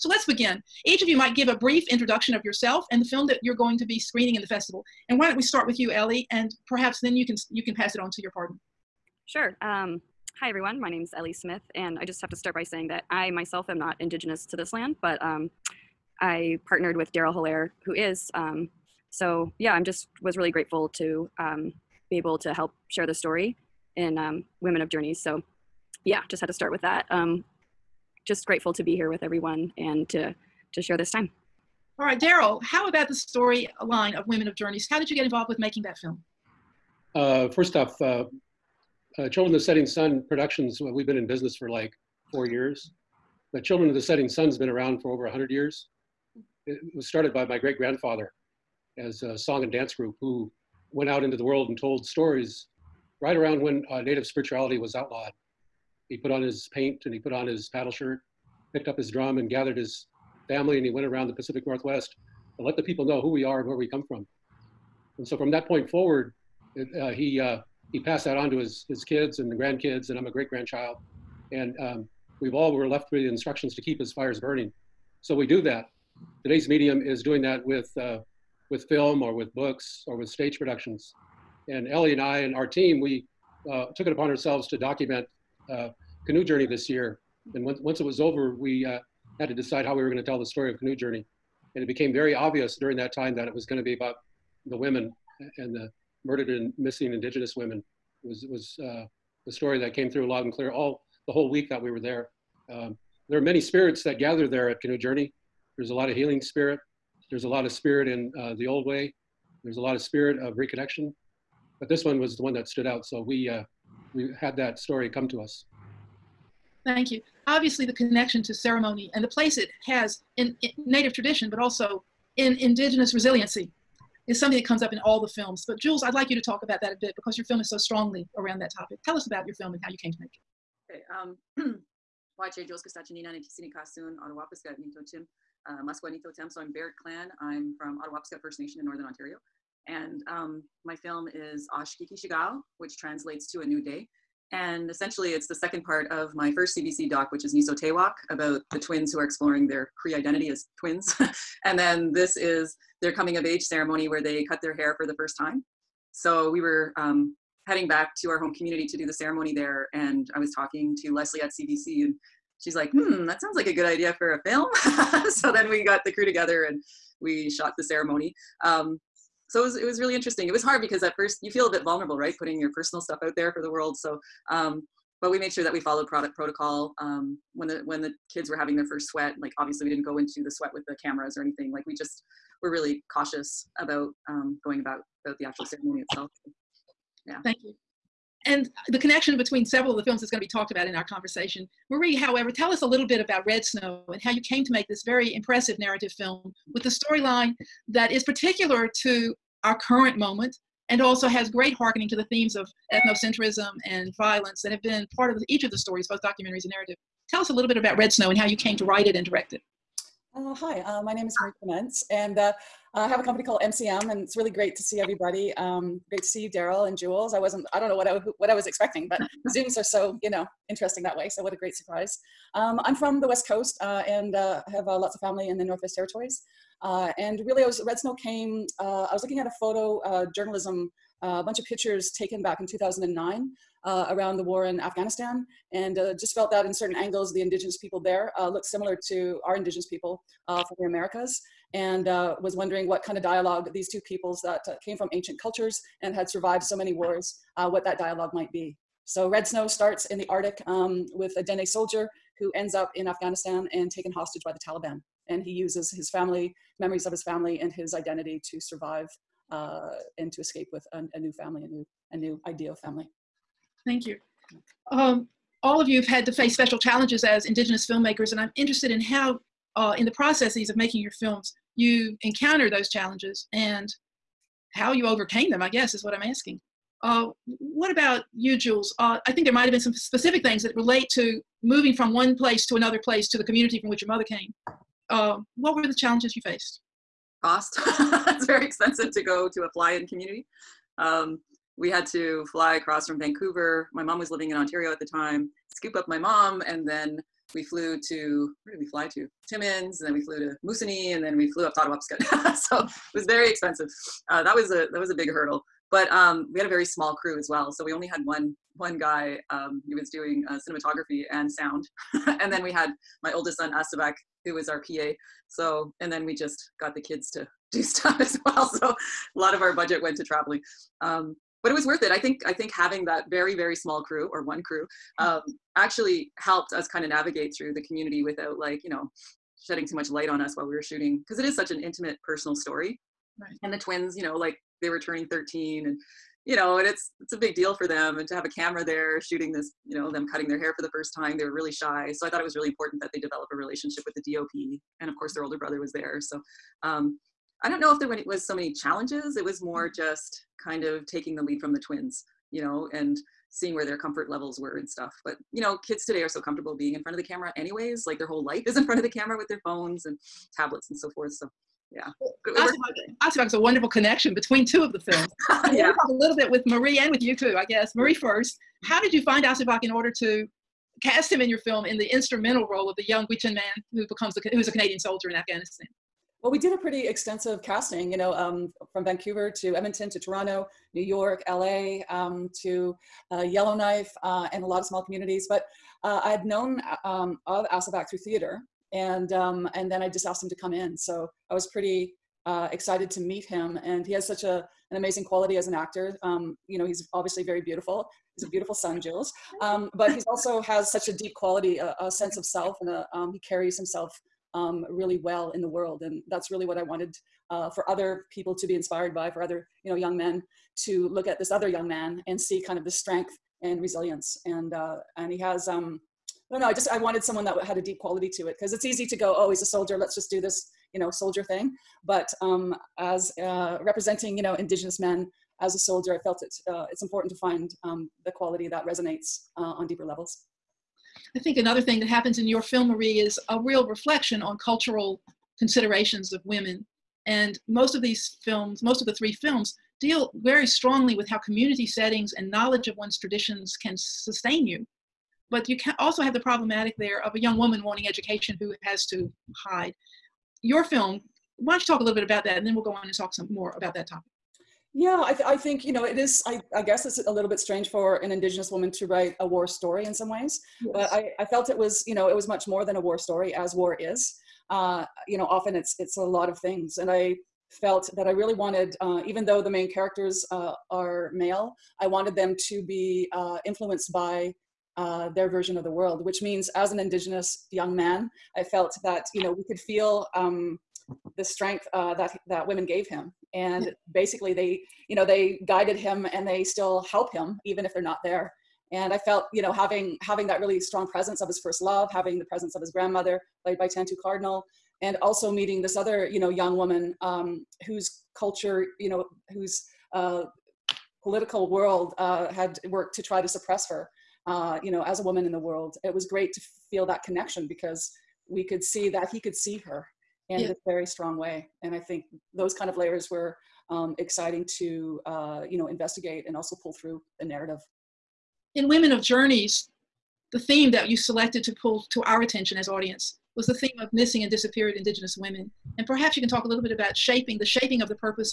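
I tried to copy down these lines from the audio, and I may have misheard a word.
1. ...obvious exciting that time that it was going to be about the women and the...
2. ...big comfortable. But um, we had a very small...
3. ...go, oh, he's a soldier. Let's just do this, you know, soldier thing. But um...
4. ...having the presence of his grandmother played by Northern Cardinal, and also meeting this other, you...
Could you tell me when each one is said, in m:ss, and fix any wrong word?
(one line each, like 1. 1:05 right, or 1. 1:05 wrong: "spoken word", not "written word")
1. 1:32 wrong: "during", not "exciting"
2. 5:05 wrong: "hurdle", not "comfortable"
3. 6:59 right
4. 8:12 wrong: "Tantoo", not "Northern".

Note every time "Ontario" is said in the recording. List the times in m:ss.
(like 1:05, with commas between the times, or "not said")
2:19, 4:54.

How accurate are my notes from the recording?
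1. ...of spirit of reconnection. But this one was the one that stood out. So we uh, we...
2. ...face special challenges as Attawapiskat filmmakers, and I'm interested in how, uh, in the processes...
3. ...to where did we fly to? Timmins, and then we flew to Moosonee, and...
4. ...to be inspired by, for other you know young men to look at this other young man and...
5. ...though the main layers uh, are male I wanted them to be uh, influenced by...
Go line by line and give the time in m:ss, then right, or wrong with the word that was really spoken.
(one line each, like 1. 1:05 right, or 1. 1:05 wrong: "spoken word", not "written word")
1. 1:49 right
2. 4:26 wrong: "Indigenous", not "Attawapiskat"
3. 4:58 right
4. 6:48 right
5. 7:49 wrong: "characters", not "layers".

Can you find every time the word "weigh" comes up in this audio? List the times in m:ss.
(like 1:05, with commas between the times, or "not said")
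not said.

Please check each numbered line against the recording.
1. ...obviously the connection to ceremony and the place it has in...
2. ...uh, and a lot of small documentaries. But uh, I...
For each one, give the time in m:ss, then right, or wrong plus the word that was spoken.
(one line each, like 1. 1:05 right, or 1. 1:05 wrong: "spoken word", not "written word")
1. 1:57 right
2. 6:24 wrong: "communities", not "documentaries".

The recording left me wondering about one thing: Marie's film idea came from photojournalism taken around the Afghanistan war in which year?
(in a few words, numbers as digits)
2009.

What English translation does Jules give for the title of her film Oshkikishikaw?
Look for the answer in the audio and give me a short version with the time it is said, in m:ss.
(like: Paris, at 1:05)
A New Day, at 2:23.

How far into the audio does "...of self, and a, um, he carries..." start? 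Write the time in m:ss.
6:42.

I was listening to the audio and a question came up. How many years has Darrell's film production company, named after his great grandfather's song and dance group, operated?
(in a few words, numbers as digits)
4.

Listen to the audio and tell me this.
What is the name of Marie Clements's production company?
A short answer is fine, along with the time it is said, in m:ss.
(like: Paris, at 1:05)
MCM, at 3:33.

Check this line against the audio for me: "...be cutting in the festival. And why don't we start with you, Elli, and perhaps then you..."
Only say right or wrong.
wrong.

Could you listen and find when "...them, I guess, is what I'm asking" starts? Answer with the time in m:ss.
4:35.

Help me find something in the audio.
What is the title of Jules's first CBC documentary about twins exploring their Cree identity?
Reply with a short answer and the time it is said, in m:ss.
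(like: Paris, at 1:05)
Niso Tewak, at 2:27.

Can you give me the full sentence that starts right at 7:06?
Uh, it's important to find um, the quality that resonates uh, on deeper levels.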